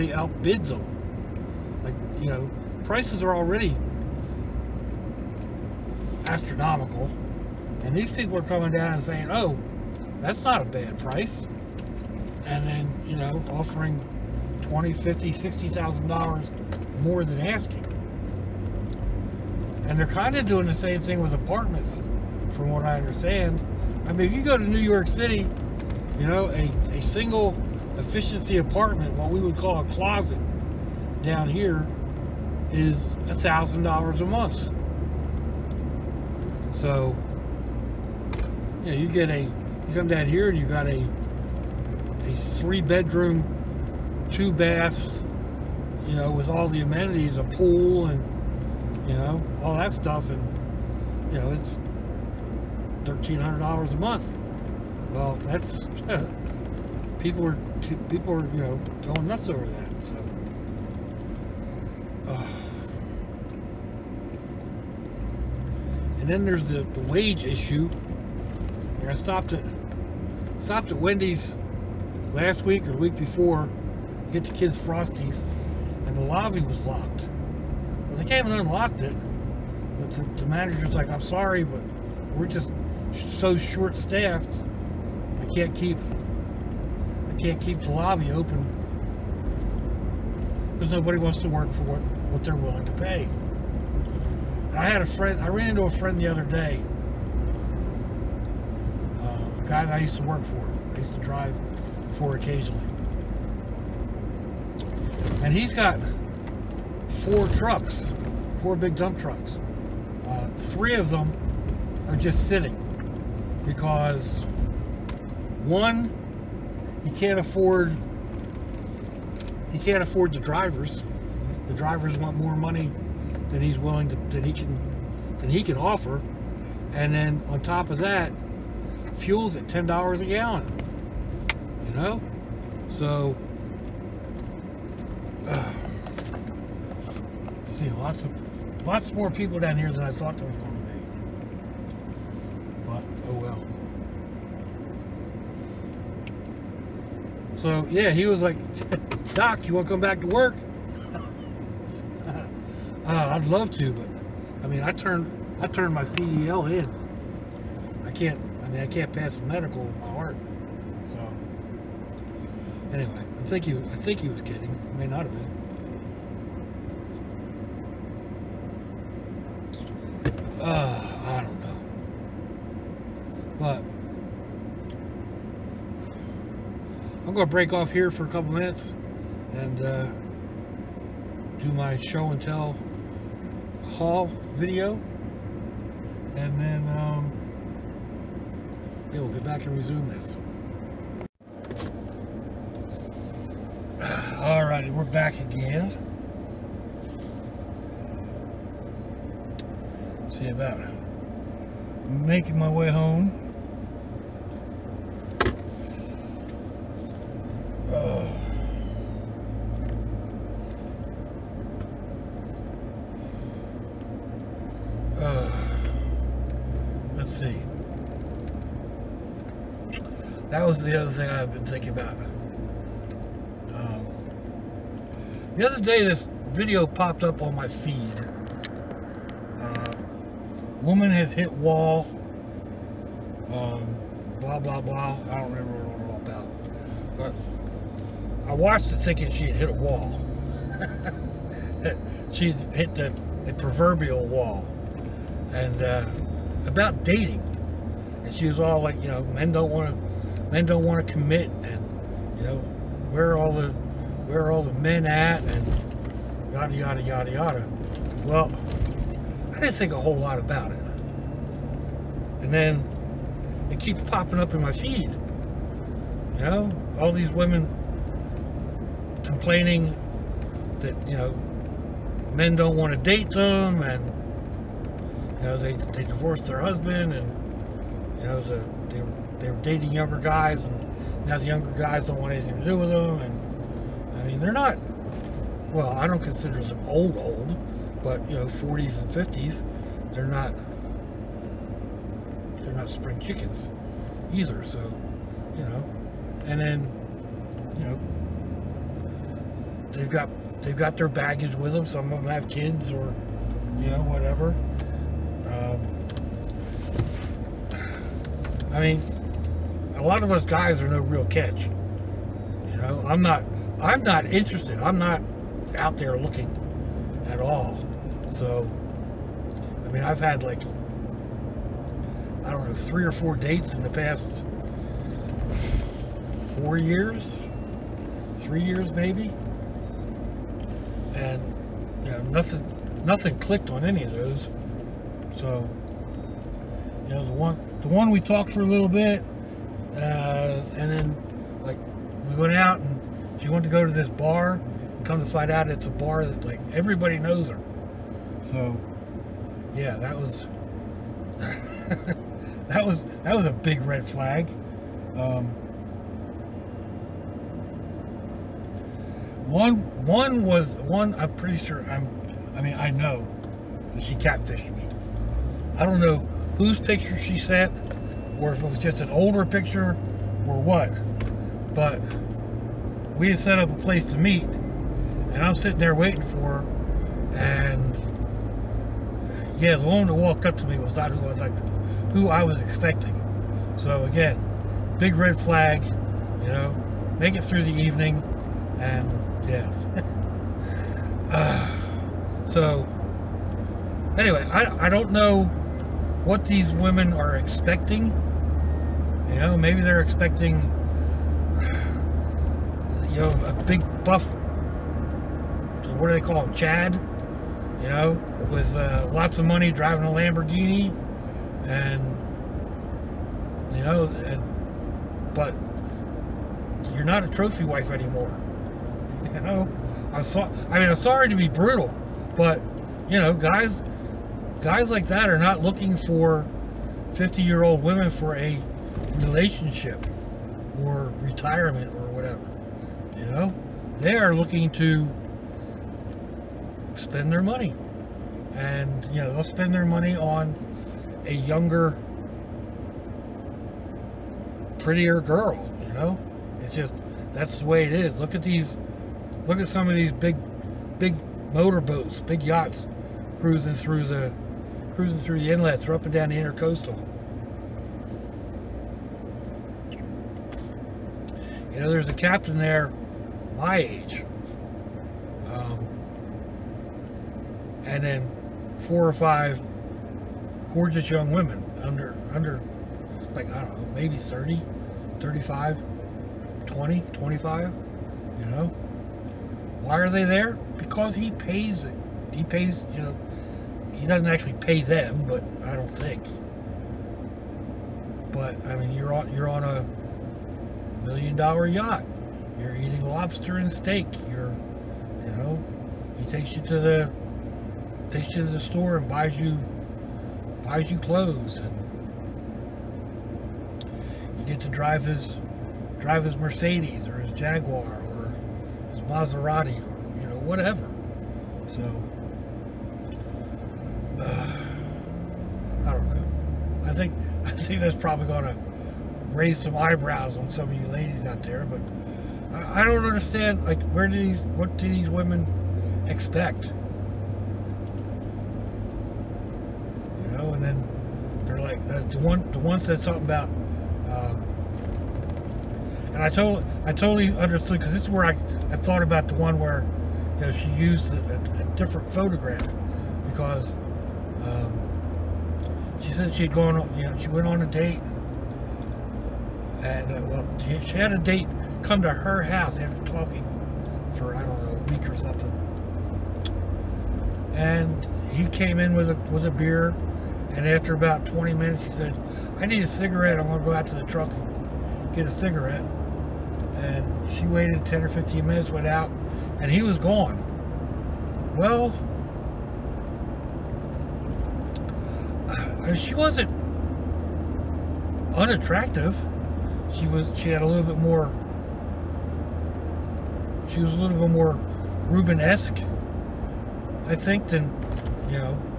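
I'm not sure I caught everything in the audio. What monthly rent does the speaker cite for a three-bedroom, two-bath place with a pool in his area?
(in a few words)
$1,300.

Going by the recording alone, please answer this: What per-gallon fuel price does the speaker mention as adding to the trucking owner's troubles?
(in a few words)
$10.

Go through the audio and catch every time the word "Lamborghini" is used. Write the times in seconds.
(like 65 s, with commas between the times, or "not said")
410 s.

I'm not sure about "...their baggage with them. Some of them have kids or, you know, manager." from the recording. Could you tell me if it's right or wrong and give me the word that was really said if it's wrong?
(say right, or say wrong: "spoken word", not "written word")
wrong: "whatever", not "manager".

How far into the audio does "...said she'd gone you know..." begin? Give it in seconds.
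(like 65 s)
546 s.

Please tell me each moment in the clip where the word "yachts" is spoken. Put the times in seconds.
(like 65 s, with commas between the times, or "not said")
452 s, 491 s.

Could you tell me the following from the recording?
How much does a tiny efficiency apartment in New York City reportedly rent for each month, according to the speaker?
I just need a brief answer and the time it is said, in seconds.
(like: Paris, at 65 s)
$1,000, at 33 s.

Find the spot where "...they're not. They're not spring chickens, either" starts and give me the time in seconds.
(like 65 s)
290 s.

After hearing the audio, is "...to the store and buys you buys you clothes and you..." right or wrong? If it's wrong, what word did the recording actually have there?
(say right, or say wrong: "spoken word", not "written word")
right.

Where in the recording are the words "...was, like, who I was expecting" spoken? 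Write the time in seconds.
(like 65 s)
381 s.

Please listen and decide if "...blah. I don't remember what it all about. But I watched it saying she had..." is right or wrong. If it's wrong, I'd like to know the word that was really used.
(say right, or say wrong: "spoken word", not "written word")
wrong: "thinking", not "saying".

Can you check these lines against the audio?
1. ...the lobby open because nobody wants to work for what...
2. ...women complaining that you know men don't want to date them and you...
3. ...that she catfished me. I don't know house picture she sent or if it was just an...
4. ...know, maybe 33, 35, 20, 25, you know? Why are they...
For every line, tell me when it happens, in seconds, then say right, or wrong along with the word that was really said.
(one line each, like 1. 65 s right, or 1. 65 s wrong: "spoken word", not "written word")
1. 87 s right
2. 267 s right
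3. 363 s wrong: "whose", not "house"
4. 473 s wrong: "30", not "33".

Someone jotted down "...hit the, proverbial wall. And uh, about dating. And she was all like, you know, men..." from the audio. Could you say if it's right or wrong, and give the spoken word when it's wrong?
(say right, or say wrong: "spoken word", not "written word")
right.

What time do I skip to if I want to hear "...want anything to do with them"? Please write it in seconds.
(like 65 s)
282 s.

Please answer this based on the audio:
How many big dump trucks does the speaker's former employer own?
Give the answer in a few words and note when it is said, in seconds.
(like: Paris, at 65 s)
4, at 108 s.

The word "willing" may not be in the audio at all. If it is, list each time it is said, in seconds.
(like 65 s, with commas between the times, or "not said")
92 s, 123 s.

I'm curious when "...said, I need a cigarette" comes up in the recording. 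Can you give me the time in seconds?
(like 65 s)
561 s.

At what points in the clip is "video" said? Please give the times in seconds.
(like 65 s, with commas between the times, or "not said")
184 s, 226 s.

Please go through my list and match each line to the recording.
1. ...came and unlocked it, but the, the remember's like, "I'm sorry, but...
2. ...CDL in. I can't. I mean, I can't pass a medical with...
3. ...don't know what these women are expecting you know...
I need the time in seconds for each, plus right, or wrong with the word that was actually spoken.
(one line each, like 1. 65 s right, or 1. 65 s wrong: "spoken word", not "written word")
1. 78 s wrong: "manager", not "remember"
2. 156 s right
3. 394 s right.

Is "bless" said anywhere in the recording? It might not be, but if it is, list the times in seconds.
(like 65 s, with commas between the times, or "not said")
not said.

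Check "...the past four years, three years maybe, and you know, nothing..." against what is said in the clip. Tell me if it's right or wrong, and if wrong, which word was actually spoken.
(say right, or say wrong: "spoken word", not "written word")
right.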